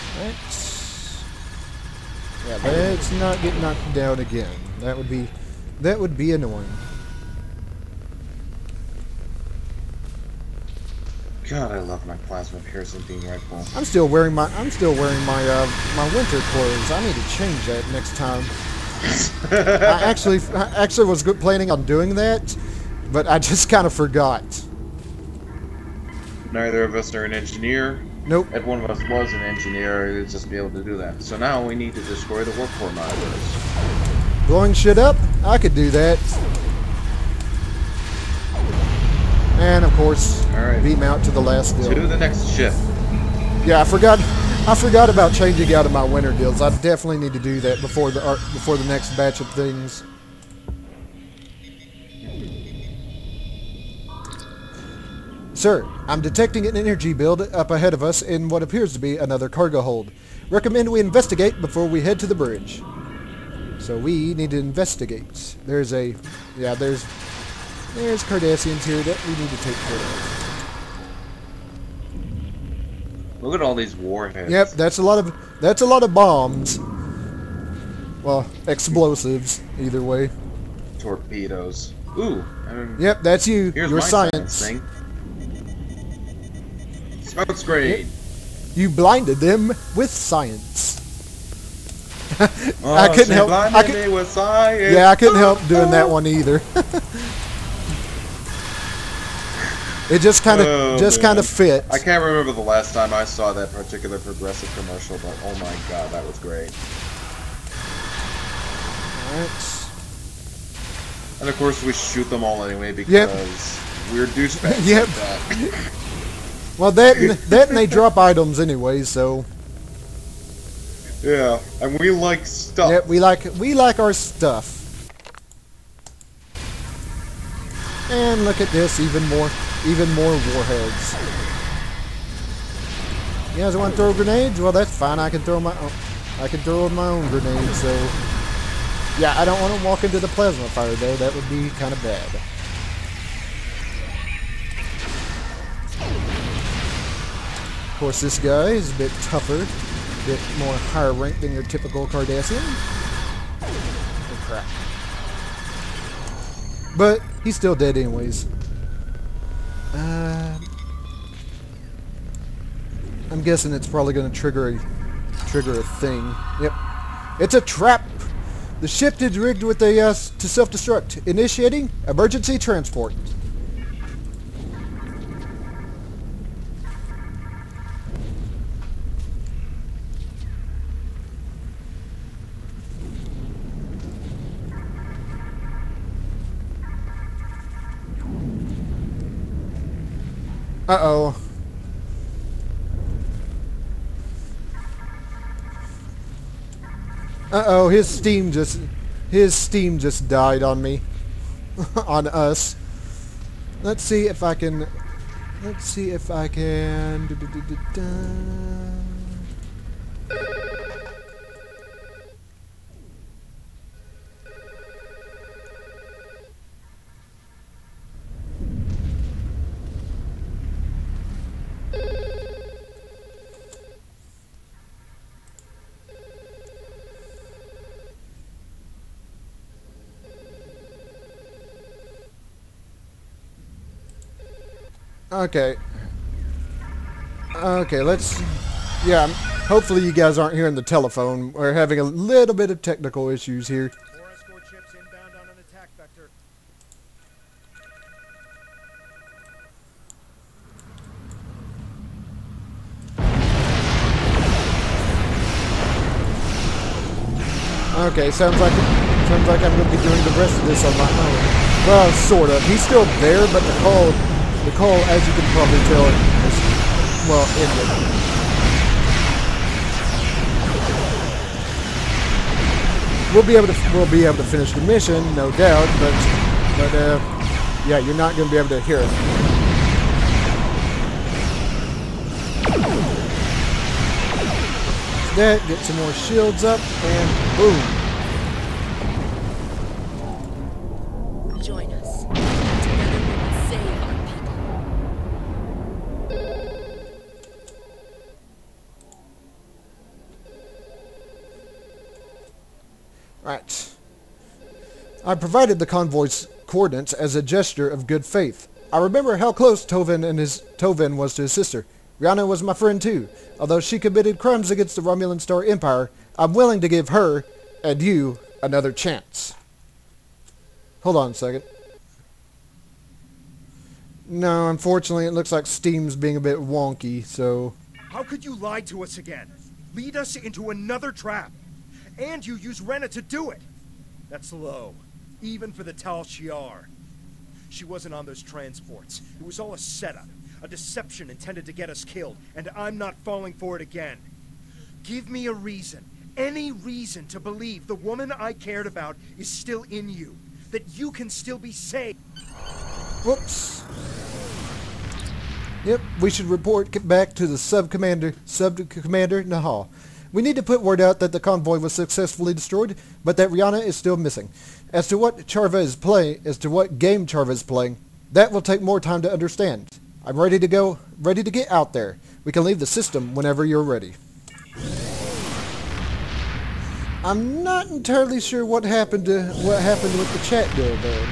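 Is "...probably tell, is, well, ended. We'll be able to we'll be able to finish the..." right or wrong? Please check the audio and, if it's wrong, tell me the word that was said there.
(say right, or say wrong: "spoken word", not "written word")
right.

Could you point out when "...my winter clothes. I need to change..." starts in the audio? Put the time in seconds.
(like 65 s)
15 s.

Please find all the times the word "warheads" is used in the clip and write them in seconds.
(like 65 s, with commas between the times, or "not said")
73 s, 130 s.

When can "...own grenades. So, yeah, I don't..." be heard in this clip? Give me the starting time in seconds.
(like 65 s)
137 s.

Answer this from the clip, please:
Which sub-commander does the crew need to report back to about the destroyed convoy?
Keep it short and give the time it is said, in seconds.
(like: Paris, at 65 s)
Nahal, at 359 s.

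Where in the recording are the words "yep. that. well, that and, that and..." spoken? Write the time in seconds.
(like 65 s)
114 s.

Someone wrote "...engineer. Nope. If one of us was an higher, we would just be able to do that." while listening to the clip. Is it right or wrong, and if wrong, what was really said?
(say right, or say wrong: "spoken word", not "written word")
wrong: "engineer", not "higher".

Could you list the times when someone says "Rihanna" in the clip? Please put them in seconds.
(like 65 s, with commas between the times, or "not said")
312 s, 363 s.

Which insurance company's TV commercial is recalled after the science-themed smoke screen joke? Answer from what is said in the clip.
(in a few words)
Progressive.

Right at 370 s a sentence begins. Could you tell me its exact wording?
I'm ready to go, ready to get out there.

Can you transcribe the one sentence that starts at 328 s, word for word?
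How could you lie to us again?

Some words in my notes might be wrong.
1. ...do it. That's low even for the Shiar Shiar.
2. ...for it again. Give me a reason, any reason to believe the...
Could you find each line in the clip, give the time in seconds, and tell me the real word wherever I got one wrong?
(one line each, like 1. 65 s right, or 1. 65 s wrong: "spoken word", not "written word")
1. 333 s wrong: "Tal", not "Shiar"
2. 343 s right.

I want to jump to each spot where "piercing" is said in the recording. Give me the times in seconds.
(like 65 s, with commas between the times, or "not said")
12 s.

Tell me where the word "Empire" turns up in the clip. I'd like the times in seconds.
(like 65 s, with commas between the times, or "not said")
315 s.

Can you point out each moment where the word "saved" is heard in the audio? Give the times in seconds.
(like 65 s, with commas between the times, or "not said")
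351 s.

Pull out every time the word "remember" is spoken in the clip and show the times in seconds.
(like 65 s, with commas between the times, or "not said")
102 s, 308 s.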